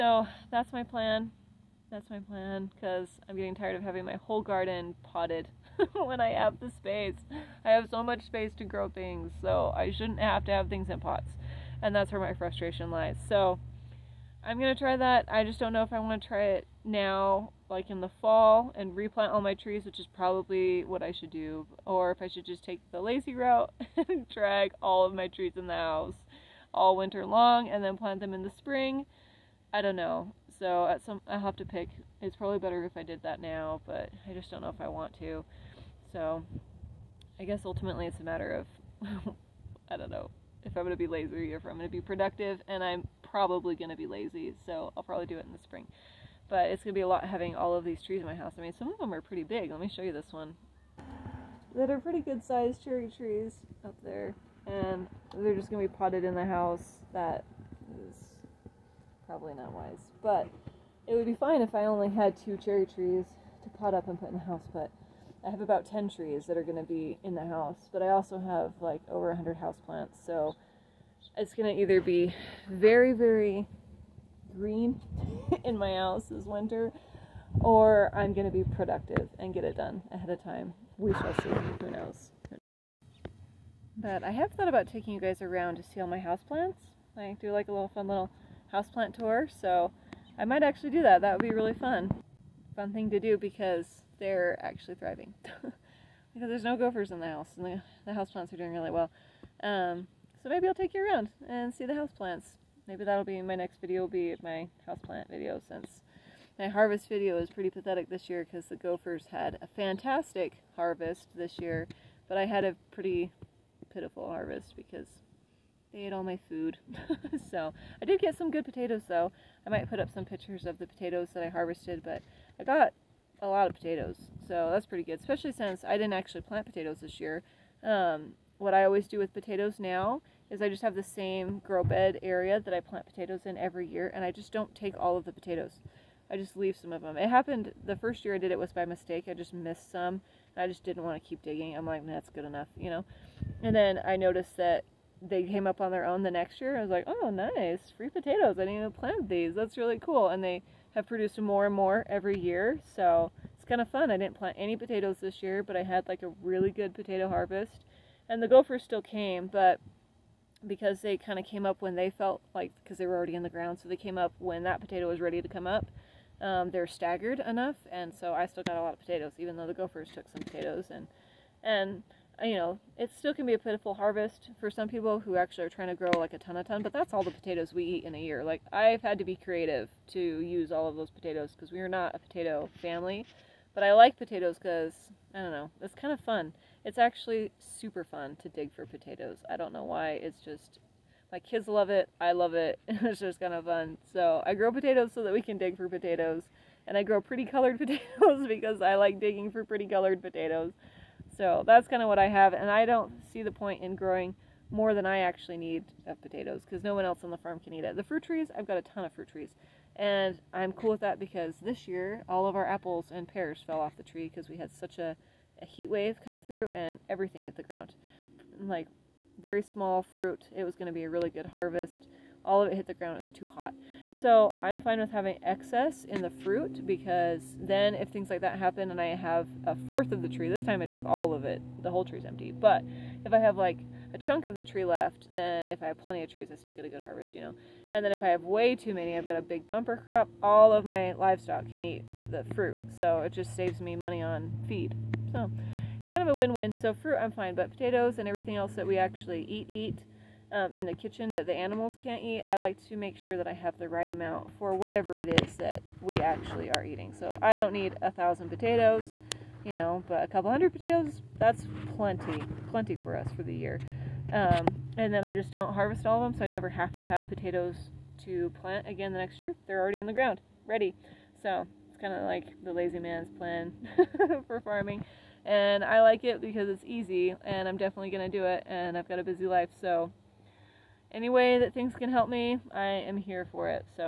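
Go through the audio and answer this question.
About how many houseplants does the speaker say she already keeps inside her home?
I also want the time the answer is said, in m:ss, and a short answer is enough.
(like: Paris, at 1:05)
over 100, at 1:09.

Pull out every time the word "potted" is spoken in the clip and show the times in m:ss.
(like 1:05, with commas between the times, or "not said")
0:05, 0:55.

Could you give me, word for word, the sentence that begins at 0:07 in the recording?
I have so much space to grow things, so I shouldn't have to have things in pots.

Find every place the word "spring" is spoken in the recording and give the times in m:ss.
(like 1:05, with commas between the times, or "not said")
0:28, 0:45.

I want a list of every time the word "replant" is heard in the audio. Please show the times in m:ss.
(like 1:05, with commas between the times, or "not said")
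0:18.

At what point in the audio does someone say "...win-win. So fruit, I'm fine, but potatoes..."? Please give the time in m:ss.
4:06.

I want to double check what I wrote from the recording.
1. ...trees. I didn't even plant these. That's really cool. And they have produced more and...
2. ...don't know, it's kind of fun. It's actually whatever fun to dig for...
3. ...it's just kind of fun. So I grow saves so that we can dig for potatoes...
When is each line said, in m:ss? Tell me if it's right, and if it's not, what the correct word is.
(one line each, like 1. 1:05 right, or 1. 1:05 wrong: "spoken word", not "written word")
1. 2:28 wrong: "potatoes", not "trees"
2. 3:05 wrong: "super", not "whatever"
3. 3:12 wrong: "potatoes", not "saves".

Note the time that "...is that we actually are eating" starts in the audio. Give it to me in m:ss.
4:15.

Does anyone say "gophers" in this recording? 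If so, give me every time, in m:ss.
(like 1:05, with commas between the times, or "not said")
1:36, 1:48, 2:38, 2:49.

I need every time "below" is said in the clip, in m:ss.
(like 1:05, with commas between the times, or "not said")
not said.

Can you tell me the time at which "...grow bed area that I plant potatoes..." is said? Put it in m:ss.
2:11.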